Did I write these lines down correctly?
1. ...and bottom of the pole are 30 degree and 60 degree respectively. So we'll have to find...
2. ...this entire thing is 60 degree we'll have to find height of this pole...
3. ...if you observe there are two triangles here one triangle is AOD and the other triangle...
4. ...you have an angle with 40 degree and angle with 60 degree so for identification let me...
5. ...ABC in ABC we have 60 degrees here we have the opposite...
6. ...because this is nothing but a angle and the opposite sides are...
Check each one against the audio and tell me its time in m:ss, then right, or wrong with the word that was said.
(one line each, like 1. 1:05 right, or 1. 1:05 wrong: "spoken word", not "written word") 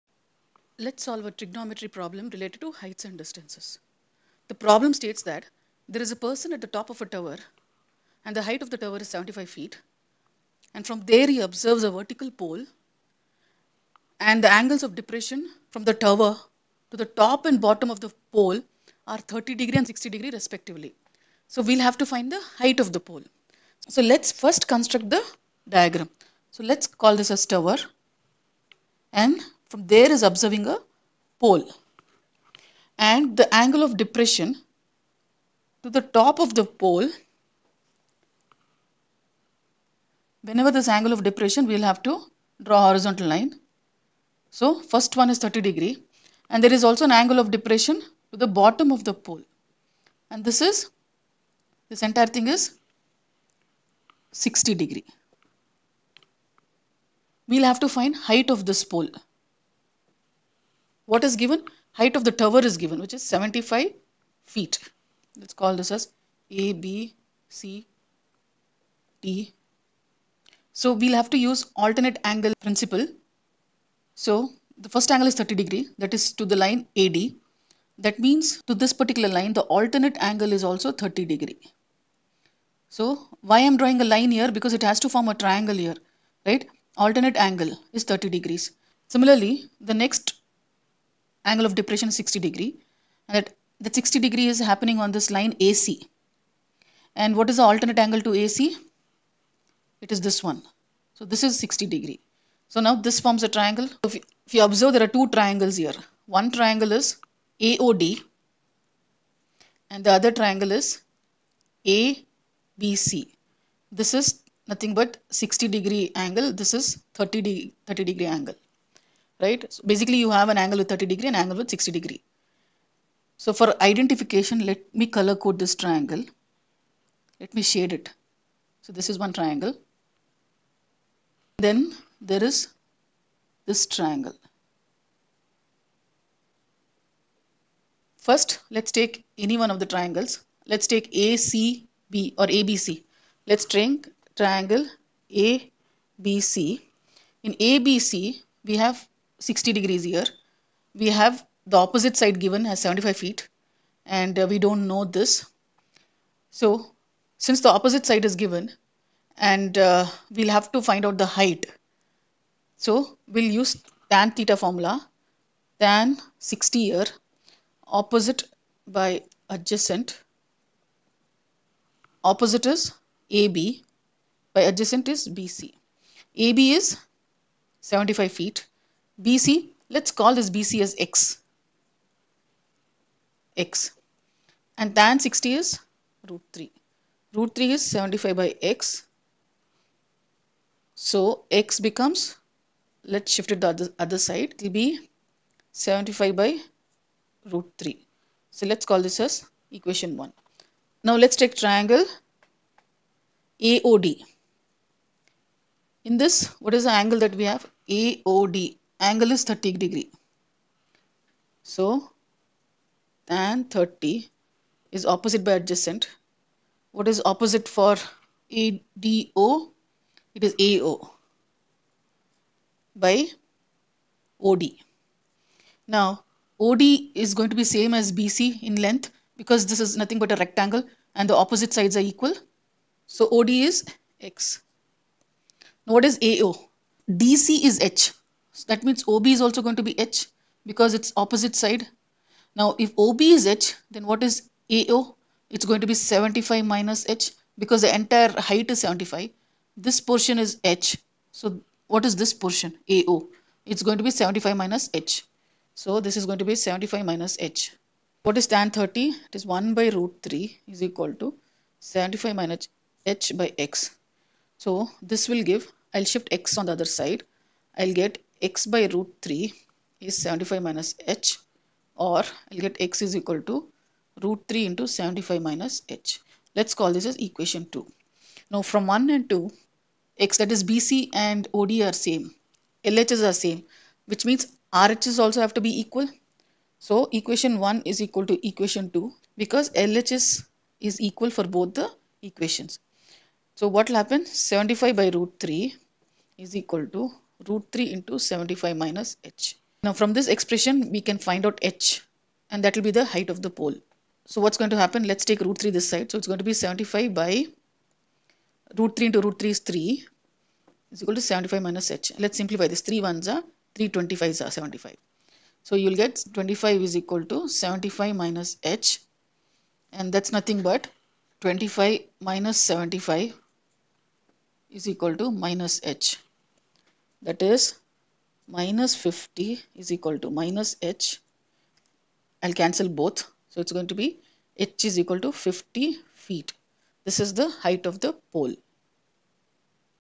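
1. 0:17 right
2. 0:51 right
3. 1:44 right
4. 2:00 wrong: "30", not "40"
5. 2:25 right
6. 3:49 wrong: "rectangle", not "angle".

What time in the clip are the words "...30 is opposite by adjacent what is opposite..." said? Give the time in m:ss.
3:33.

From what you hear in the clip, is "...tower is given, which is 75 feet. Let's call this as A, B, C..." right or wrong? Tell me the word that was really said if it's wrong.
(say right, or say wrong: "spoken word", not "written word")
right.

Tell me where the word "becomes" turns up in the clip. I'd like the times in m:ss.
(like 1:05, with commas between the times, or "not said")
3:11.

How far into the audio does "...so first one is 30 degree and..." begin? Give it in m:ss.
0:44.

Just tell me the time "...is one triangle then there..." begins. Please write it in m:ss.
2:09.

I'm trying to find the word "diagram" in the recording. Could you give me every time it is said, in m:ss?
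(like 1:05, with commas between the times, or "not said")
0:25.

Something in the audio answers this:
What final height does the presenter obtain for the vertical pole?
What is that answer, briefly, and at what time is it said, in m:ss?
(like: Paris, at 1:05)
50 feet, at 5:35.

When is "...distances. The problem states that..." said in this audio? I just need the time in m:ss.
0:03.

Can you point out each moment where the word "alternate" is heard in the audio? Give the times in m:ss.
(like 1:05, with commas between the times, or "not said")
1:11, 1:19, 1:26, 1:37.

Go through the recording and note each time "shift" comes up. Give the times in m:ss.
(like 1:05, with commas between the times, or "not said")
3:13, 4:26.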